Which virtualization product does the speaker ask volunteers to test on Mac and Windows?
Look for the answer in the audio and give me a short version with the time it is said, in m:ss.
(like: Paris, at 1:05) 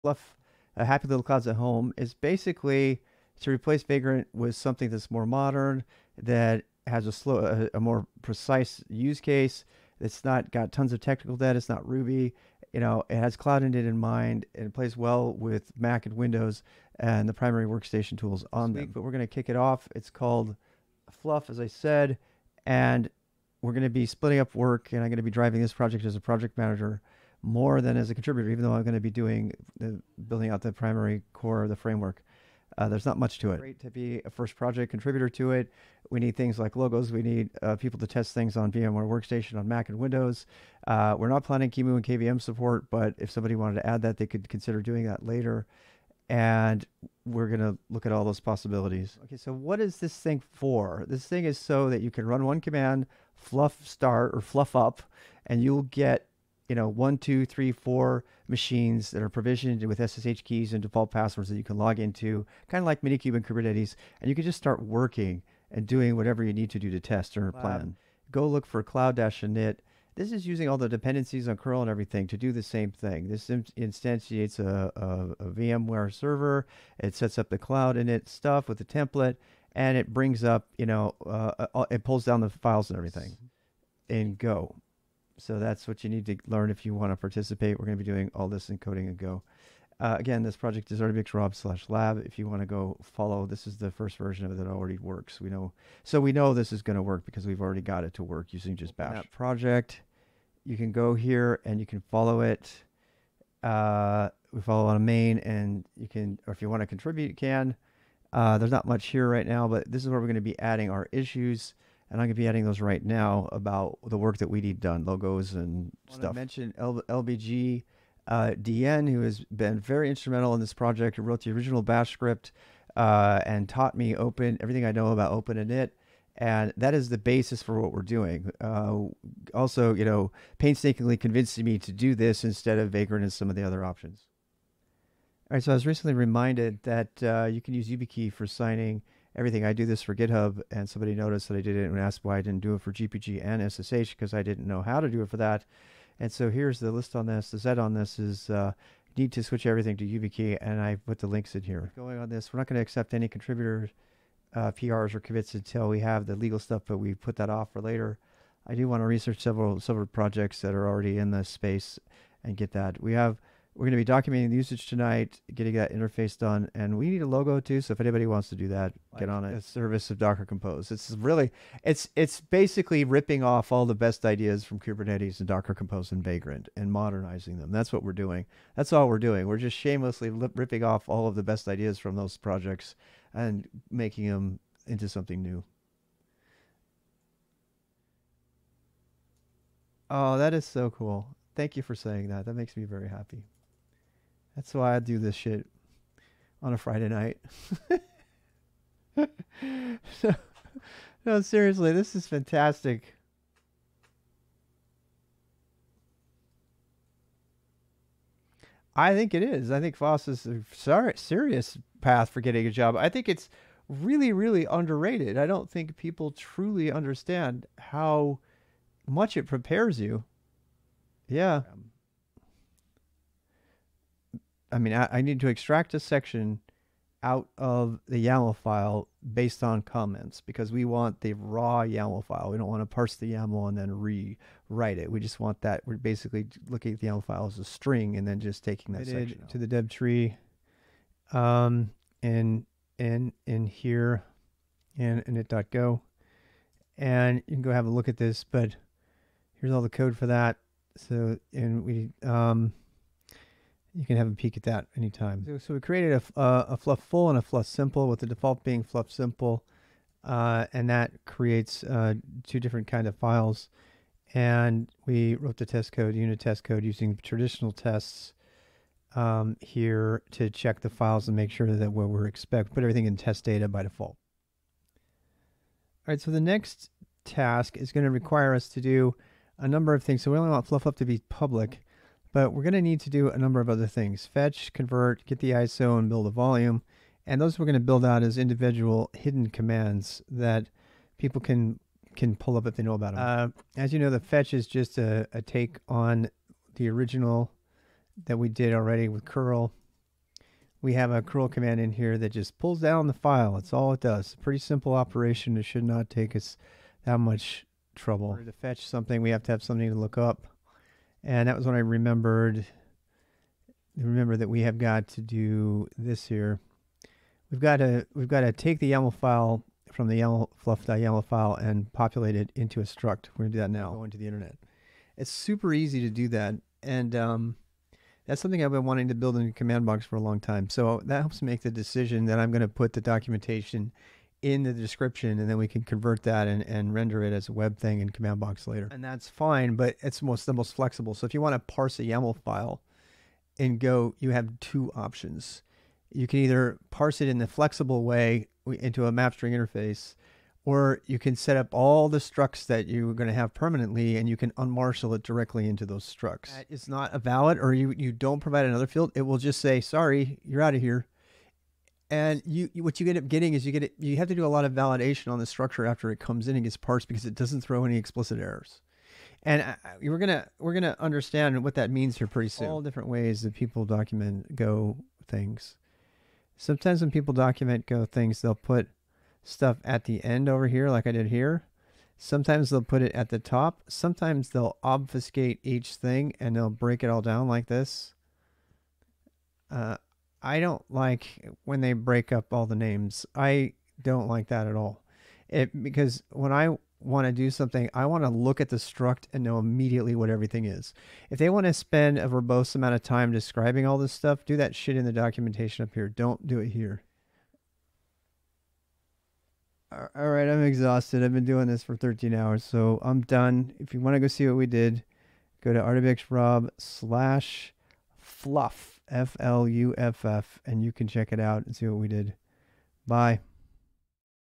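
VMware Workstation, at 0:38.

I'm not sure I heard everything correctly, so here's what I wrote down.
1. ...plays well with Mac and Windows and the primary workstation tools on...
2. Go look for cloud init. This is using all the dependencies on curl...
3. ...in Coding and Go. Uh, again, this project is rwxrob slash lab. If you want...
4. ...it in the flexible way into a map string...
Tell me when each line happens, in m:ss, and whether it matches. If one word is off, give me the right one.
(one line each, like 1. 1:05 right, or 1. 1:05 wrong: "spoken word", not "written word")
1. 0:14 right
2. 1:08 right
3. 1:28 right
4. 5:47 right.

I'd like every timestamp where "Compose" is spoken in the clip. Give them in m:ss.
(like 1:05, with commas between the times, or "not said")
2:50, 2:55.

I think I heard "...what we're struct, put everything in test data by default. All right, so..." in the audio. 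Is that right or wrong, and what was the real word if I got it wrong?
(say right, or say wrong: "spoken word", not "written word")
wrong: "expect", not "struct".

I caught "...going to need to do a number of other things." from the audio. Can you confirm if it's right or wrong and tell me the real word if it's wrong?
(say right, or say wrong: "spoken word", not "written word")
right.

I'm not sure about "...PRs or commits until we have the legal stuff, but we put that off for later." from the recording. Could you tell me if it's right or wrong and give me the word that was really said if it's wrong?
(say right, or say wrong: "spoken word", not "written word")
right.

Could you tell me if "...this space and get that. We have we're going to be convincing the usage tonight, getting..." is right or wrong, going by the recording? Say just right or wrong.
wrong.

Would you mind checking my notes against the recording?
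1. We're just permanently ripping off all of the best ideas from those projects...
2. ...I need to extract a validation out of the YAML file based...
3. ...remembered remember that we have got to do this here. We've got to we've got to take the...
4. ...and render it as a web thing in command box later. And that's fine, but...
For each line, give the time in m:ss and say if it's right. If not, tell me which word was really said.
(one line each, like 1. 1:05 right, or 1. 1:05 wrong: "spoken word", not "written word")
1. 2:59 wrong: "shamelessly", not "permanently"
2. 3:45 wrong: "section", not "validation"
3. 5:11 right
4. 5:36 right.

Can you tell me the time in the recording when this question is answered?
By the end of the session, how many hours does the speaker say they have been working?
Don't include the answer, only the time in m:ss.
6:51.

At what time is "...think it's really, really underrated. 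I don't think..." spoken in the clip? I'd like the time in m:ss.
3:33.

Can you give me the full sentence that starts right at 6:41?
If they want to spend a verbose amount of time describing all this stuff, do that shit in the documentation up here.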